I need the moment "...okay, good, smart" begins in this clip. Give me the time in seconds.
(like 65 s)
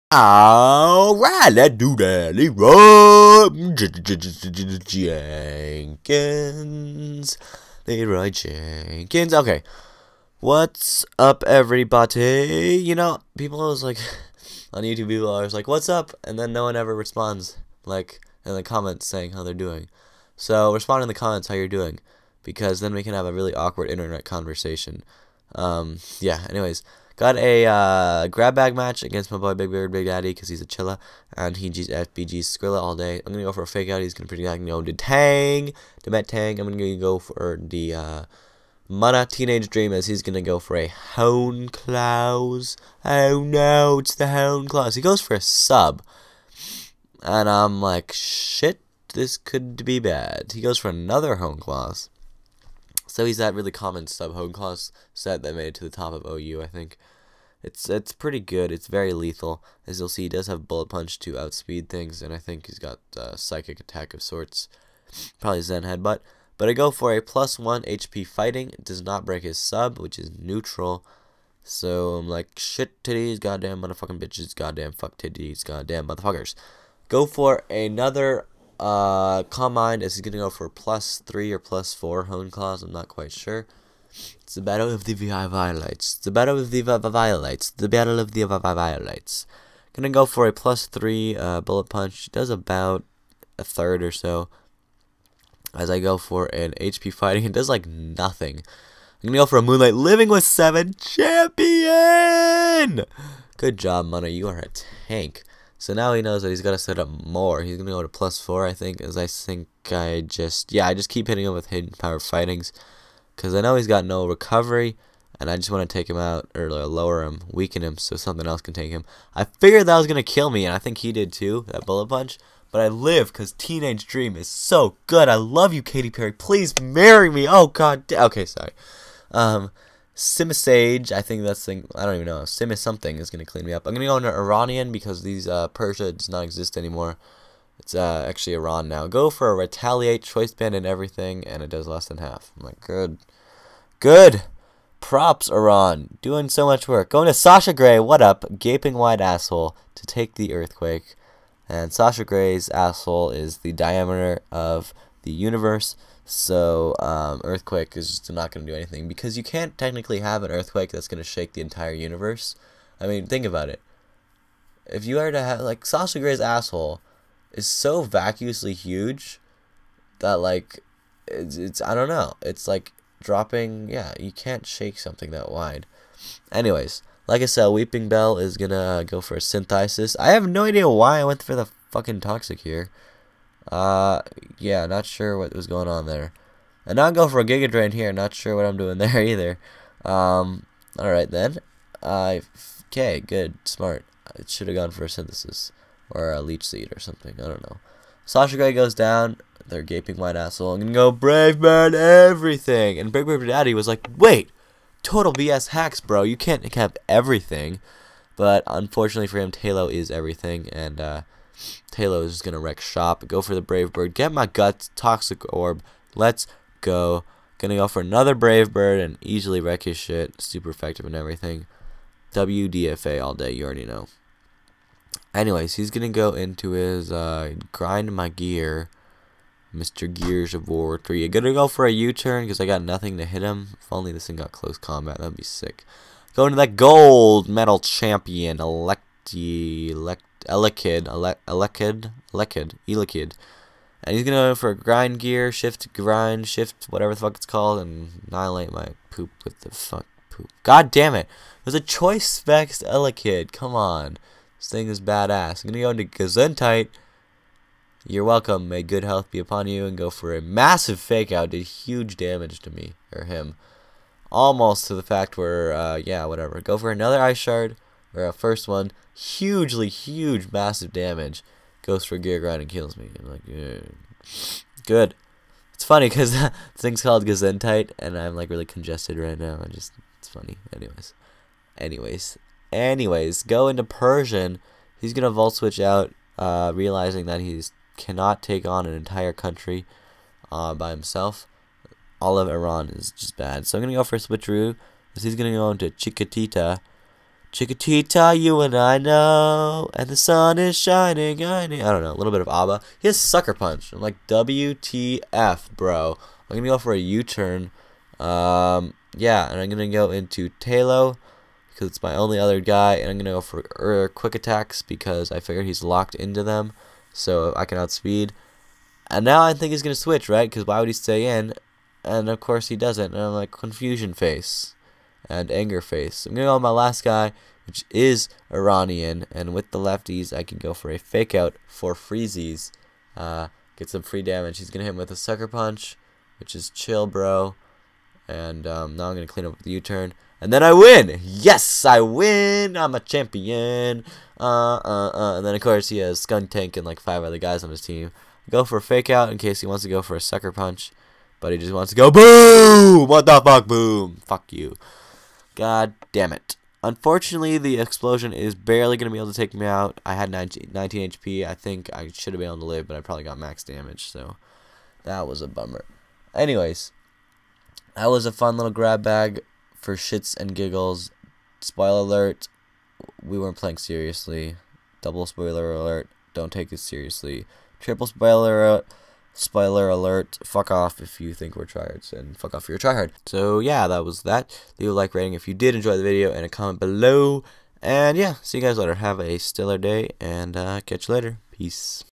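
192 s.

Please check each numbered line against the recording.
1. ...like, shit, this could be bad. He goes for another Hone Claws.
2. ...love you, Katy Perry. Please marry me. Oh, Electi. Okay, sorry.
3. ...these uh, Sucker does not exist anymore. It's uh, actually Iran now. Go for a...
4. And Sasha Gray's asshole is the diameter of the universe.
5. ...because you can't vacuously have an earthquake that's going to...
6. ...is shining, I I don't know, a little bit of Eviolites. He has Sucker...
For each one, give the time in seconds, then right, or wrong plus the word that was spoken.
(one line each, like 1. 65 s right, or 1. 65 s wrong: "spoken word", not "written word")
1. 47 s right
2. 125 s wrong: "God", not "Electi"
3. 135 s wrong: "Persia", not "Sucker"
4. 151 s right
5. 159 s wrong: "technically", not "vacuously"
6. 300 s wrong: "ABBA", not "Eviolites".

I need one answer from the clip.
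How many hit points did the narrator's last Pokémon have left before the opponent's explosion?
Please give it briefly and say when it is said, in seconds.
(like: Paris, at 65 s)
19, at 360 s.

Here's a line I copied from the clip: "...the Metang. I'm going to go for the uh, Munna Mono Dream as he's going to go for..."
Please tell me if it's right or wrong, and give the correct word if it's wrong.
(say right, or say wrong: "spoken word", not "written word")
wrong: "Teenage", not "Mono".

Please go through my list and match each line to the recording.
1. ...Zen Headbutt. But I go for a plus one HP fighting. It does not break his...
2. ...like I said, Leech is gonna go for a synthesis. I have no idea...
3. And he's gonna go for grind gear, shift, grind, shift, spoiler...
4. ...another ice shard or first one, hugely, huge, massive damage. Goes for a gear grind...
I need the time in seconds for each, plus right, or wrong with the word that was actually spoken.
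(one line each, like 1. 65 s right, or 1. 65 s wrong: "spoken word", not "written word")
1. 65 s right
2. 177 s wrong: "Weepinbell", not "Leech"
3. 244 s wrong: "whatever", not "spoiler"
4. 266 s right.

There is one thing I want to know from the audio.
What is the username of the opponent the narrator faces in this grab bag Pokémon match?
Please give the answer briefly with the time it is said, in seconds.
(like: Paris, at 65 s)
BigBirdBigDaddy, at 29 s.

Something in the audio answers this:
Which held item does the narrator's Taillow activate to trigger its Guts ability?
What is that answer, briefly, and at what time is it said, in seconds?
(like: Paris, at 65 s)
Toxic Orb, at 214 s.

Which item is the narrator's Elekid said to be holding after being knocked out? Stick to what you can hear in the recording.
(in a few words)
Choice Specs.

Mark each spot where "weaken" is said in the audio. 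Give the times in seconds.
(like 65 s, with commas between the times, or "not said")
117 s.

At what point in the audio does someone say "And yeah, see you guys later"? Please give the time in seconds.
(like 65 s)
387 s.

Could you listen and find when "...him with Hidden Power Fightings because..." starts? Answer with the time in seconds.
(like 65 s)
111 s.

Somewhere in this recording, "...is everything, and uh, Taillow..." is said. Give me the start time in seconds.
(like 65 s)
209 s.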